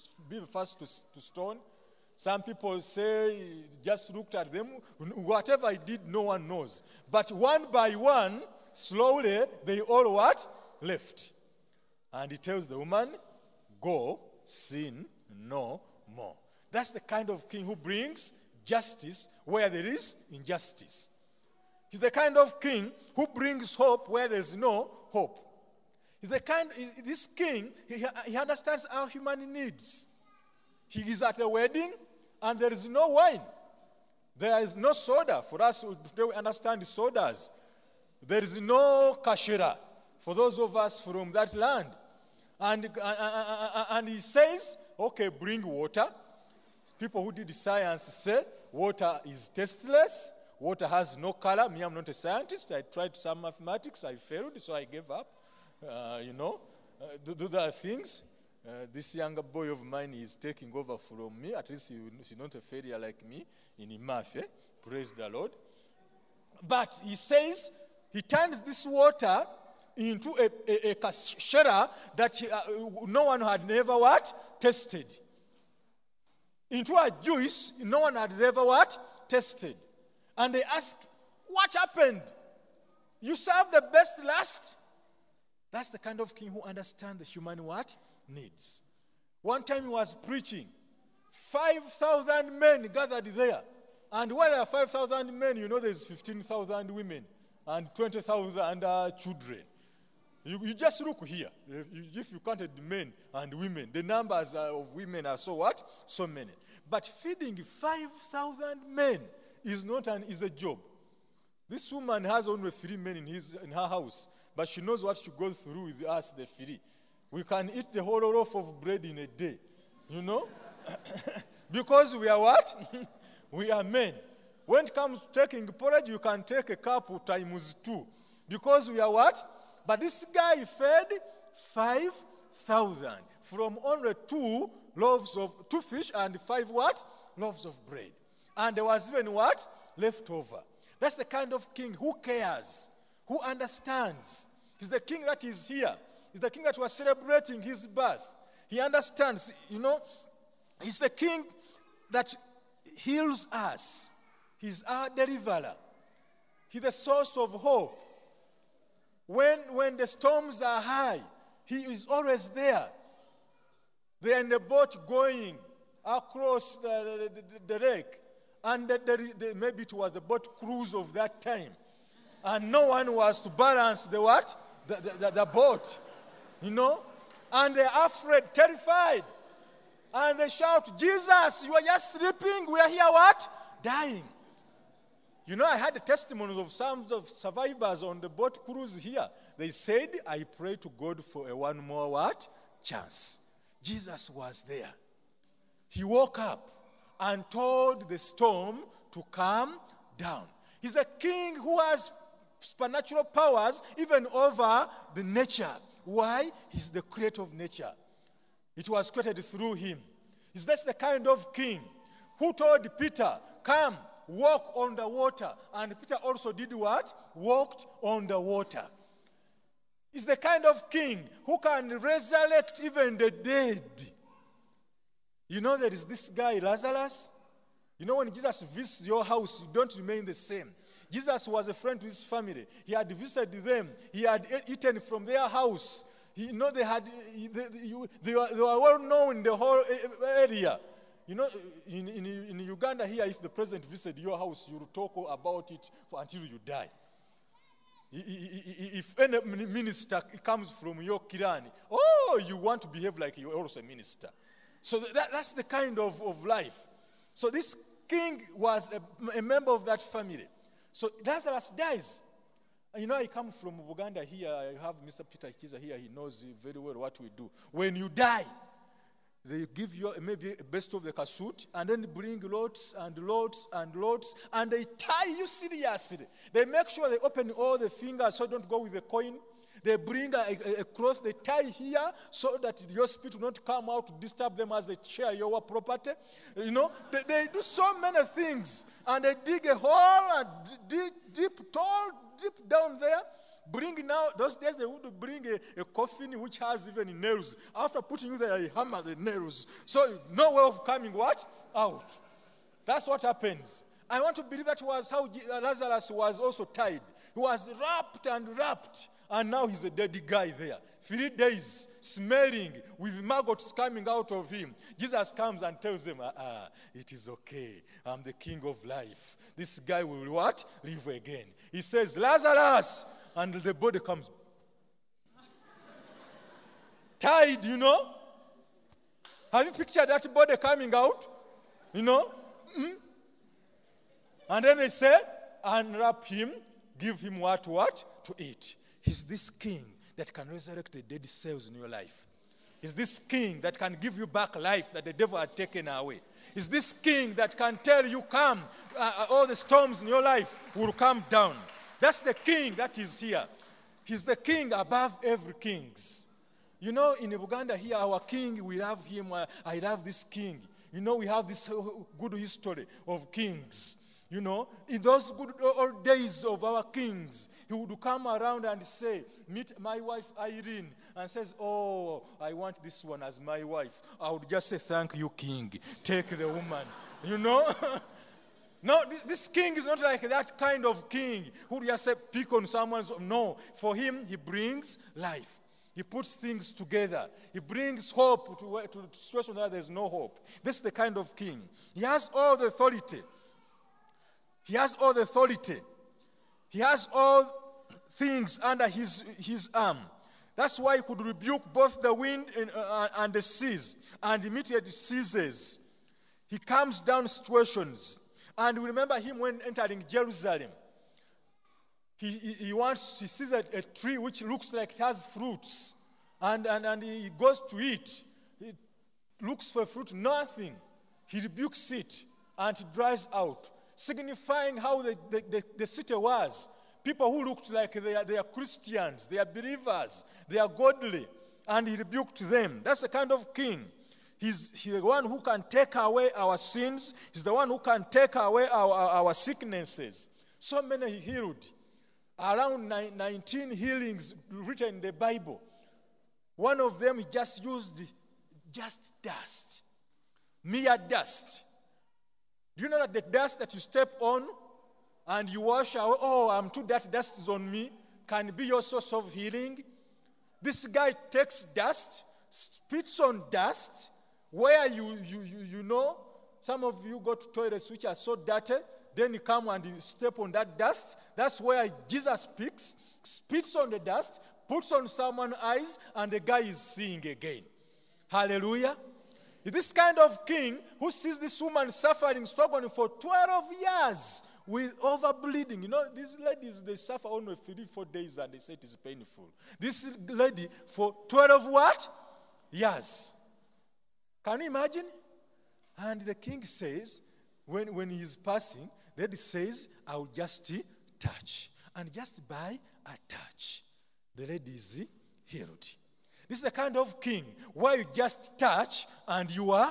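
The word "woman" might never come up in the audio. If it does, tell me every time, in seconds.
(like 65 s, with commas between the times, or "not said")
12 s, 111 s, 376 s, 481 s.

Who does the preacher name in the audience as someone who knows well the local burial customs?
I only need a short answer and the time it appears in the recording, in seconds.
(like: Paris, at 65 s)
Peter Kiza, at 265 s.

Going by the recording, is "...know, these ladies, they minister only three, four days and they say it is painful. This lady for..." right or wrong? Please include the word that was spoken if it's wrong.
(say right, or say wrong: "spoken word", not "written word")
wrong: "suffer", not "minister".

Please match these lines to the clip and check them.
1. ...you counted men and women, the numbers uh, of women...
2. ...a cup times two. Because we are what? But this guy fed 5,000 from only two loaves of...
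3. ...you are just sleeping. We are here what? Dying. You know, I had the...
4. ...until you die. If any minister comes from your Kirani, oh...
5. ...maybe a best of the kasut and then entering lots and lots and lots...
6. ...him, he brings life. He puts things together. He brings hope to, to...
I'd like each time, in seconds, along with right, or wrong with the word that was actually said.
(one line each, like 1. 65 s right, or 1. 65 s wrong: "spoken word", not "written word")
1. 102 s right
2. 126 s right
3. 181 s right
4. 246 s right
5. 270 s wrong: "bring", not "entering"
6. 383 s right.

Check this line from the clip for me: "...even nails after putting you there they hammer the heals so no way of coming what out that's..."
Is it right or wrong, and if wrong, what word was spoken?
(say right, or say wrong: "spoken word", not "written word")
wrong: "nails", not "heals".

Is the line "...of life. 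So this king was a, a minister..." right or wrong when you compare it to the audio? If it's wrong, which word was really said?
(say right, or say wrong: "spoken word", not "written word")
wrong: "member", not "minister".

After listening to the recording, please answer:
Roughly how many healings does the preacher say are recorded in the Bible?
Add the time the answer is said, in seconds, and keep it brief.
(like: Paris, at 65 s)
19, at 443 s.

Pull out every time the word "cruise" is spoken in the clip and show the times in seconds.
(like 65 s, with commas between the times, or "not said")
170 s, 188 s.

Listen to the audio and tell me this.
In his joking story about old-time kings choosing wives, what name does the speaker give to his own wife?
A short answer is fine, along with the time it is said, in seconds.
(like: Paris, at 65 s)
Irene, at 370 s.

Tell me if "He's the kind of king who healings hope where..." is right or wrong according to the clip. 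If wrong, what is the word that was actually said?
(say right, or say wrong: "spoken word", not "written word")
wrong: "brings", not "healings".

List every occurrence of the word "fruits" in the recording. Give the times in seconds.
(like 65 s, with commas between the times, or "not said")
415 s, 419 s.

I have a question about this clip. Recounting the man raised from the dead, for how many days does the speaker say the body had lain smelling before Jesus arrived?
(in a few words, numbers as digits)
3.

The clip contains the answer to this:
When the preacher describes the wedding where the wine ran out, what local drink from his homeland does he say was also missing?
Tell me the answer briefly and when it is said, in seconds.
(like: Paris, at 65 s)
kashira, at 39 s.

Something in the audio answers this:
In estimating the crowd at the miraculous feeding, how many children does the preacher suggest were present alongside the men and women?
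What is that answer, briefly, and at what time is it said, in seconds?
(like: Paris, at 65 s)
20,000, at 97 s.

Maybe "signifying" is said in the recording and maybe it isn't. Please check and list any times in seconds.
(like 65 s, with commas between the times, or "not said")
424 s.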